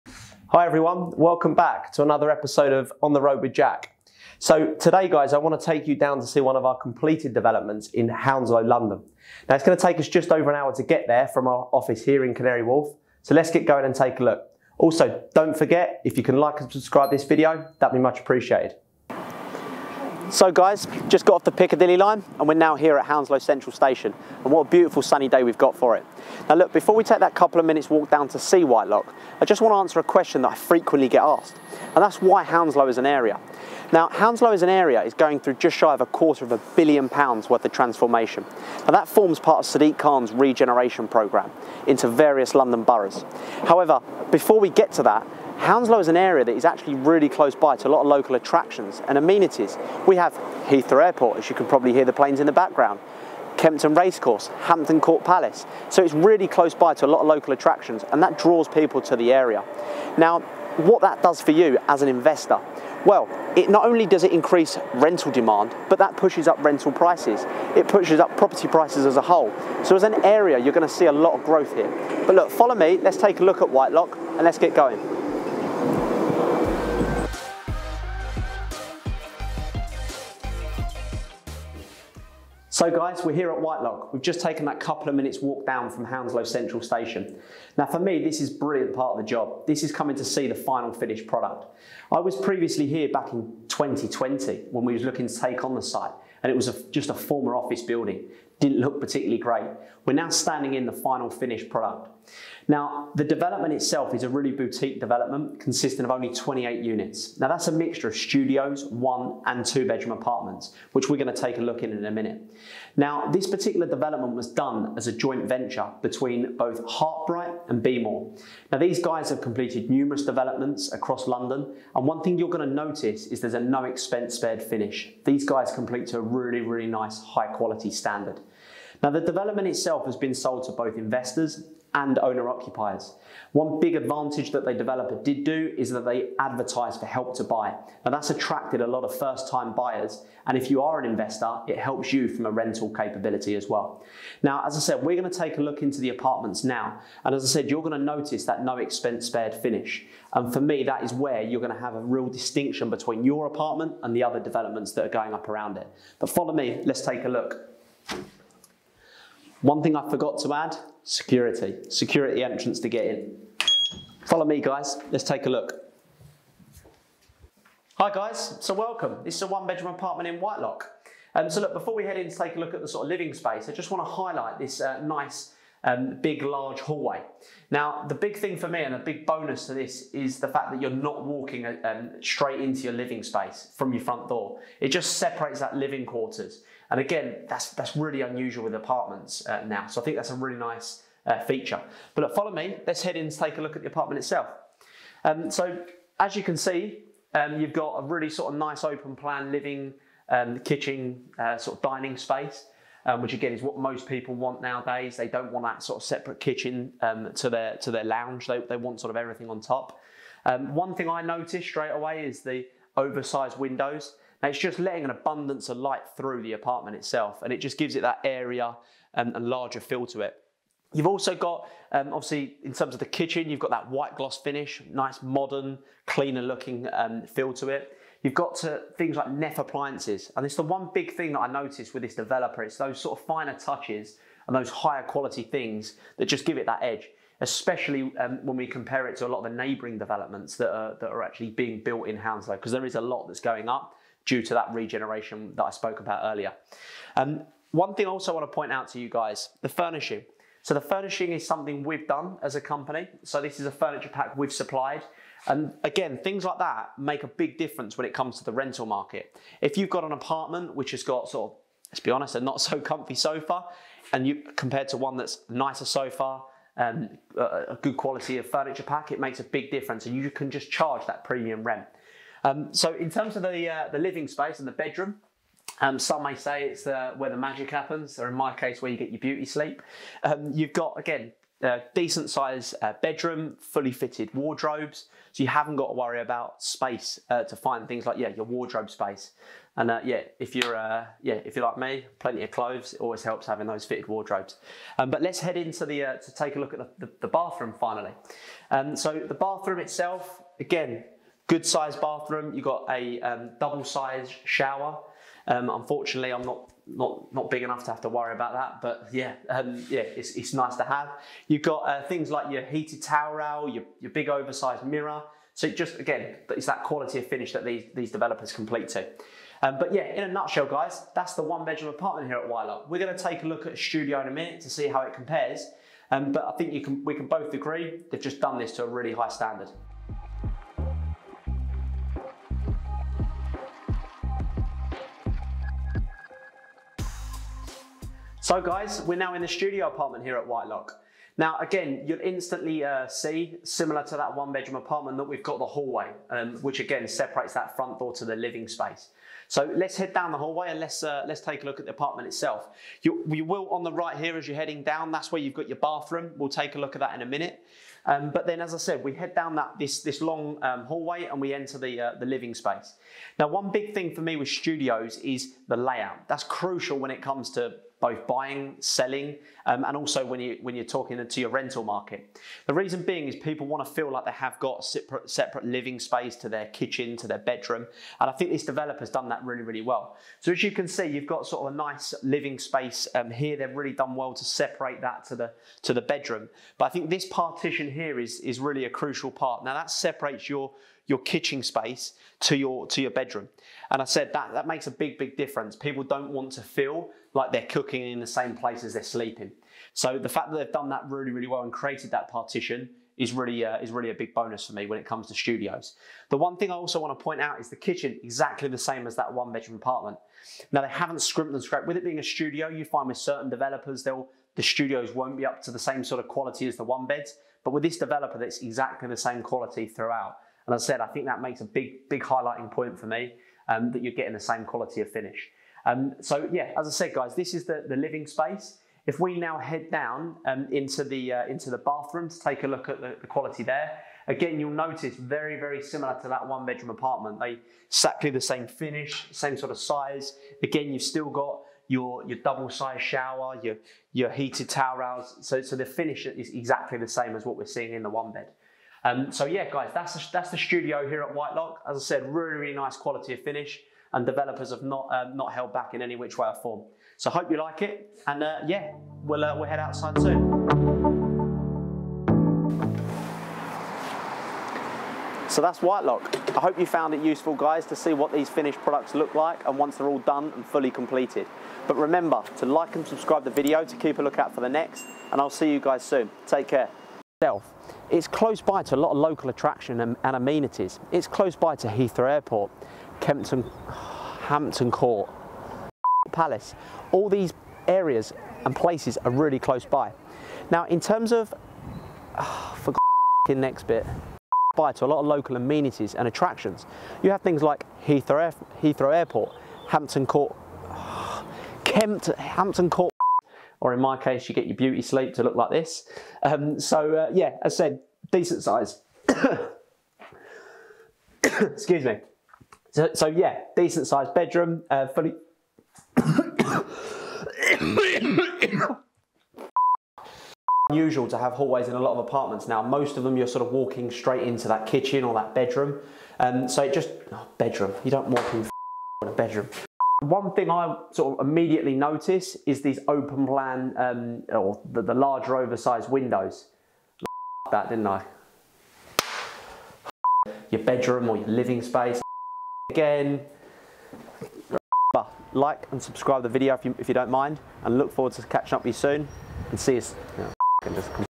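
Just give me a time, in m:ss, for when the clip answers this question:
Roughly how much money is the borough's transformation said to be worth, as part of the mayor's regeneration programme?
0:35.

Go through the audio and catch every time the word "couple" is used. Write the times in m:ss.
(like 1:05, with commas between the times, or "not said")
0:27, 1:24.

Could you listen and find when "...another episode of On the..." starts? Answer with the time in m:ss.
0:02.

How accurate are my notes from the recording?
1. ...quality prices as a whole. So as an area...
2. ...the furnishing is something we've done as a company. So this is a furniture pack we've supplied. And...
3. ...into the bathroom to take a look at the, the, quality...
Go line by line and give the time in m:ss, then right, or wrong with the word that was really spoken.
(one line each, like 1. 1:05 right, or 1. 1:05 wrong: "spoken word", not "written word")
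1. 1:08 wrong: "property", not "quality"
2. 4:10 right
3. 7:11 right.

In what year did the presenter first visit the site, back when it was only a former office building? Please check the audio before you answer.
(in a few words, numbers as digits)
2020.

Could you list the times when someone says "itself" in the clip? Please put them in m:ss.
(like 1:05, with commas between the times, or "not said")
1:43, 2:09, 3:14, 3:36, 4:59, 5:52, 7:57.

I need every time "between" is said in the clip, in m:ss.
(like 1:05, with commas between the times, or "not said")
1:56, 2:32.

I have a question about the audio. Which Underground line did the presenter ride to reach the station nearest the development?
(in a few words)
Piccadilly line.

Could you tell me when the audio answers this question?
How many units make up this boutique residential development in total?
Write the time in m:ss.
1:46.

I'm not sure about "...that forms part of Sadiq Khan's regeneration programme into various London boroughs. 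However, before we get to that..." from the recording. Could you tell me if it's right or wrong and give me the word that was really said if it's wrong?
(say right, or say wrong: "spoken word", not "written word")
right.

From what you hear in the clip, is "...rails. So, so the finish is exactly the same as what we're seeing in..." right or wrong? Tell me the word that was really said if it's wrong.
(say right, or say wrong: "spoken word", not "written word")
right.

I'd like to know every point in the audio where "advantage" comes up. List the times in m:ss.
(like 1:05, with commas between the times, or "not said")
2:13.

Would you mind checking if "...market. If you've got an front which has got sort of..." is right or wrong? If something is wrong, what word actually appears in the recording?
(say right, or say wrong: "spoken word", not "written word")
wrong: "apartment", not "front".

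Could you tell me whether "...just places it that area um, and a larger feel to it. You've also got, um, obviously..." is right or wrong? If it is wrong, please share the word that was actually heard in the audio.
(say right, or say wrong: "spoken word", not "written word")
wrong: "gives", not "places".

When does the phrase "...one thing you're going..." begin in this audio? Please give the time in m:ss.
2:02.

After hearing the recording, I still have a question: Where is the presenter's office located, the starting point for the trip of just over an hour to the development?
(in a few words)
Canary Wharf.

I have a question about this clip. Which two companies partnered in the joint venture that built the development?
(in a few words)
Heartbright and Beemore.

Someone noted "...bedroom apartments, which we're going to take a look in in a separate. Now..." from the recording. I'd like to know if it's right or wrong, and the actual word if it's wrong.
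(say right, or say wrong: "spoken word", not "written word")
wrong: "minute", not "separate".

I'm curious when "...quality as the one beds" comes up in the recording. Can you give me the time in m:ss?
6:56.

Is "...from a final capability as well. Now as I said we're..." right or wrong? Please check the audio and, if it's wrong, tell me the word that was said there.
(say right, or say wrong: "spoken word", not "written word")
wrong: "rental", not "final".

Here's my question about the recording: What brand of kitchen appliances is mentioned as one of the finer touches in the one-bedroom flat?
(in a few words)
Neff.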